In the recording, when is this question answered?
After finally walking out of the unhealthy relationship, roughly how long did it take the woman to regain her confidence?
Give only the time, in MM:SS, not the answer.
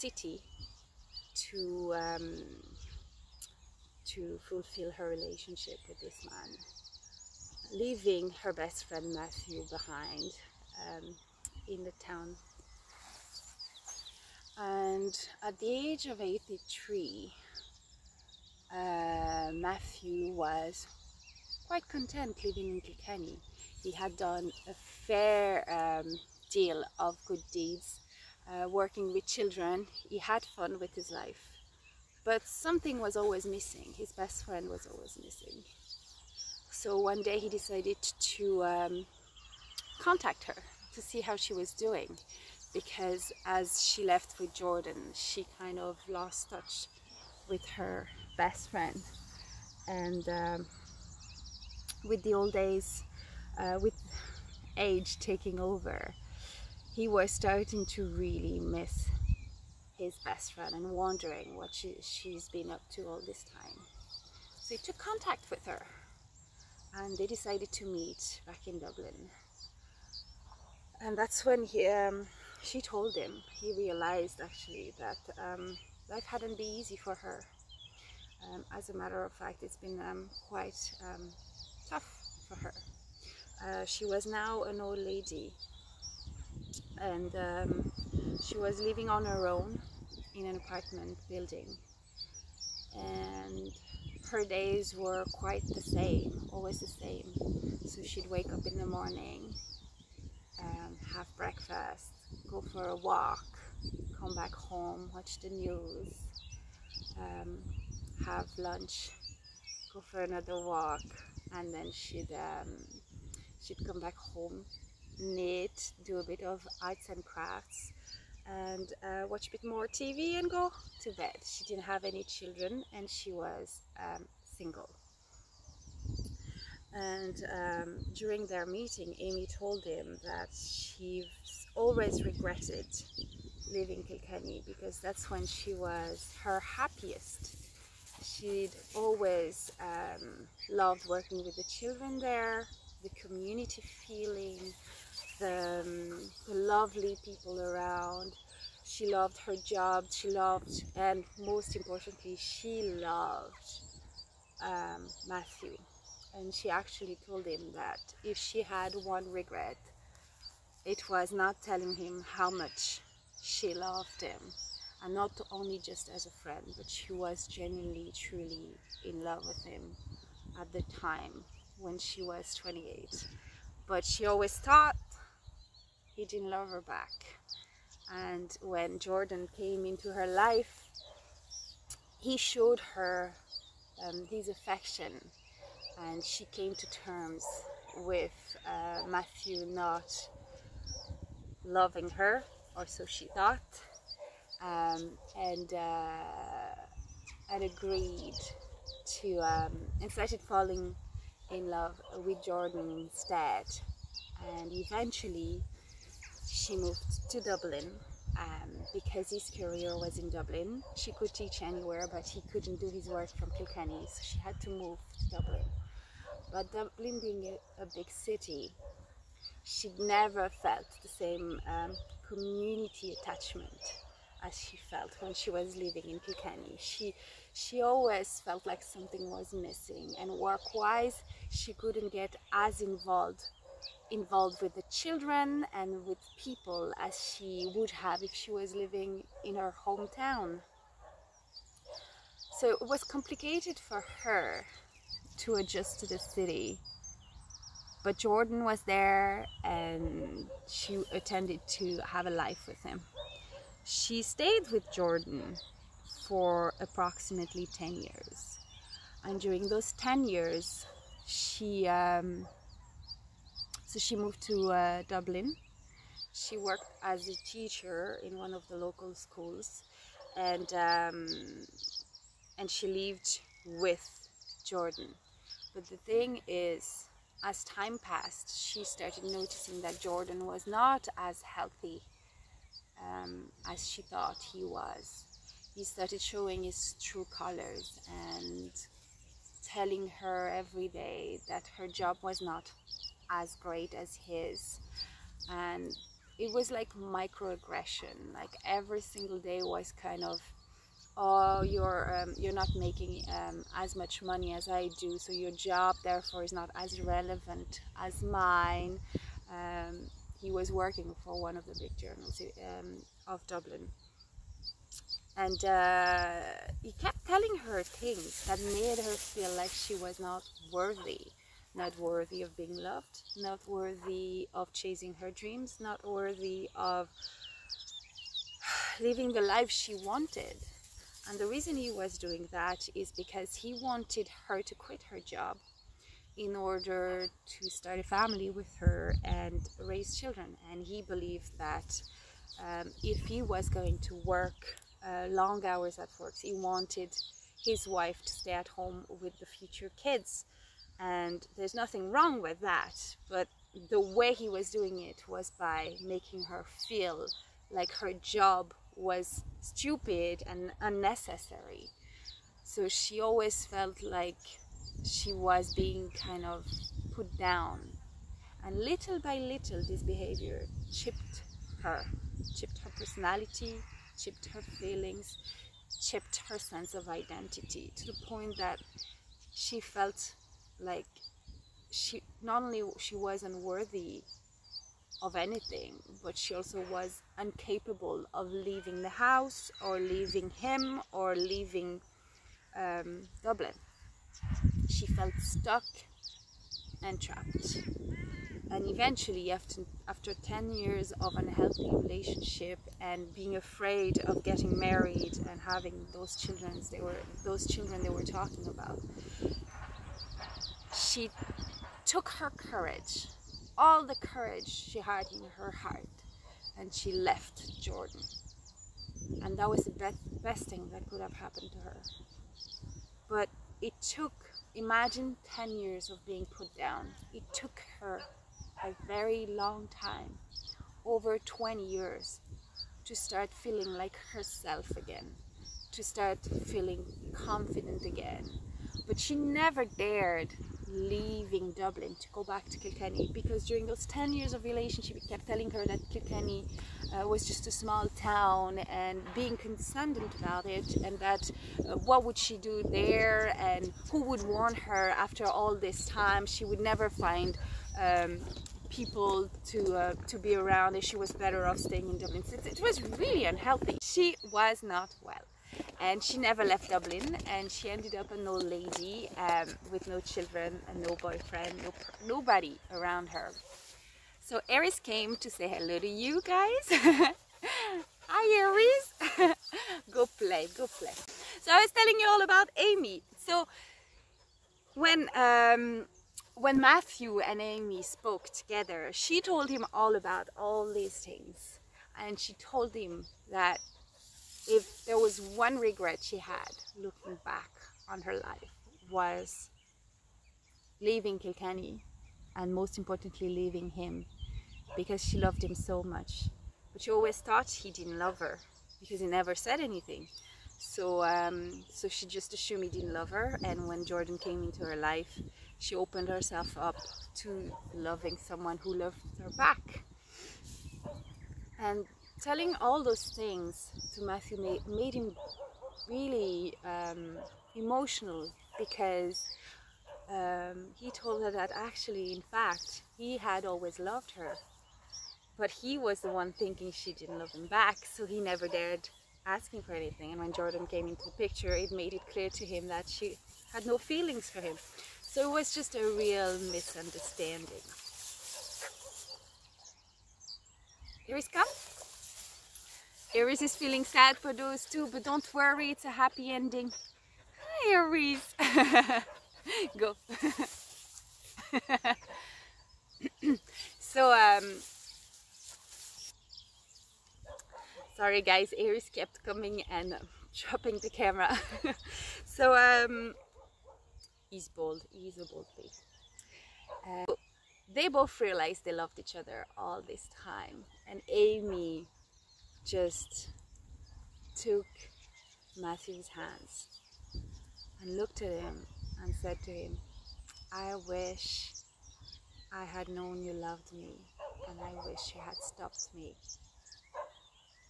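07:11.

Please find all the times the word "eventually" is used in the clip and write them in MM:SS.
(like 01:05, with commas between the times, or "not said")
03:24, 06:38.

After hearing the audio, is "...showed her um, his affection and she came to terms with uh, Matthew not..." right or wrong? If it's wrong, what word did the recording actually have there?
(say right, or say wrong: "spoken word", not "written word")
right.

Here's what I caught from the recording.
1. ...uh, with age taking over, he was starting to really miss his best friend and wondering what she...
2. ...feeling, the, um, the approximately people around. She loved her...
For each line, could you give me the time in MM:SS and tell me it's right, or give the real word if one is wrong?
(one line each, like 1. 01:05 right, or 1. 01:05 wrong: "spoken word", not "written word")
1. 00:53 right
2. 02:24 wrong: "lovely", not "approximately".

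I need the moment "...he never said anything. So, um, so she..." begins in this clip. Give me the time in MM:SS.
08:29.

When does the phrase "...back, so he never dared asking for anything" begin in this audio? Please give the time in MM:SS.
08:57.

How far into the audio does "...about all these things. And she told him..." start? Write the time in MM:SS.
08:10.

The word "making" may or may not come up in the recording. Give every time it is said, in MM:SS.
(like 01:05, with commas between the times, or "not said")
05:02, 05:56.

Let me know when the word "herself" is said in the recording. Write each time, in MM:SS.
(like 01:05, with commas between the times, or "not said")
07:14, 08:36.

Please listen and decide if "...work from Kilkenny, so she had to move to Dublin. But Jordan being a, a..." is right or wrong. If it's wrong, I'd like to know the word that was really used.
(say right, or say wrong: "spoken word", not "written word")
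wrong: "Dublin", not "Jordan".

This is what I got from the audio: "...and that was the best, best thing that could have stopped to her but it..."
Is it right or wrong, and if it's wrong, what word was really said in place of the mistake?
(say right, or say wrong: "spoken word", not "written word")
wrong: "happened", not "stopped".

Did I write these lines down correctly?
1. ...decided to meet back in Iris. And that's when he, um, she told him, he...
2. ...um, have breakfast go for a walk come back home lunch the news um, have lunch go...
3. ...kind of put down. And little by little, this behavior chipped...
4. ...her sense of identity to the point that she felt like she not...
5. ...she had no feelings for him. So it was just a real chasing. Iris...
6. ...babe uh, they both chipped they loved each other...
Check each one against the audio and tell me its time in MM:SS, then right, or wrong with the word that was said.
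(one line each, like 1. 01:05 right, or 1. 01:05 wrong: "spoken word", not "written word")
1. 01:07 wrong: "Dublin", not "Iris"
2. 01:40 wrong: "watch", not "lunch"
3. 06:06 right
4. 06:16 right
5. 09:03 wrong: "misunderstanding", not "chasing"
6. 09:35 wrong: "realized", not "chipped".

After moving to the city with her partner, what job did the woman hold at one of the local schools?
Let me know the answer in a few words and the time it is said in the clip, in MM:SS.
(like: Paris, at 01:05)
Teacher, at 04:27.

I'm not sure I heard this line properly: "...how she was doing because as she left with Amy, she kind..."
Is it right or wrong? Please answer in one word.
wrong.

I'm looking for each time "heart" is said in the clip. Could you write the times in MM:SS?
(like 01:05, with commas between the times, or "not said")
06:55.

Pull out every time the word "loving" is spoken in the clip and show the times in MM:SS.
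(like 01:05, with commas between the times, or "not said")
03:11, 08:37.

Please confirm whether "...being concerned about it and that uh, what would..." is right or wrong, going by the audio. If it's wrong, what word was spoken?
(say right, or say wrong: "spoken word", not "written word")
right.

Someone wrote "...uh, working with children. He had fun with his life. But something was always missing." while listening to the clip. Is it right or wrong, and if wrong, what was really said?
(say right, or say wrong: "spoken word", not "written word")
right.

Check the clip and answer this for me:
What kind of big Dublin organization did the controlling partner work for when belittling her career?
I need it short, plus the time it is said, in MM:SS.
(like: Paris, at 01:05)
One of the big journals, at 05:11.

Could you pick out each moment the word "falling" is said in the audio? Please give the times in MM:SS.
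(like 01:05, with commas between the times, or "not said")
03:20.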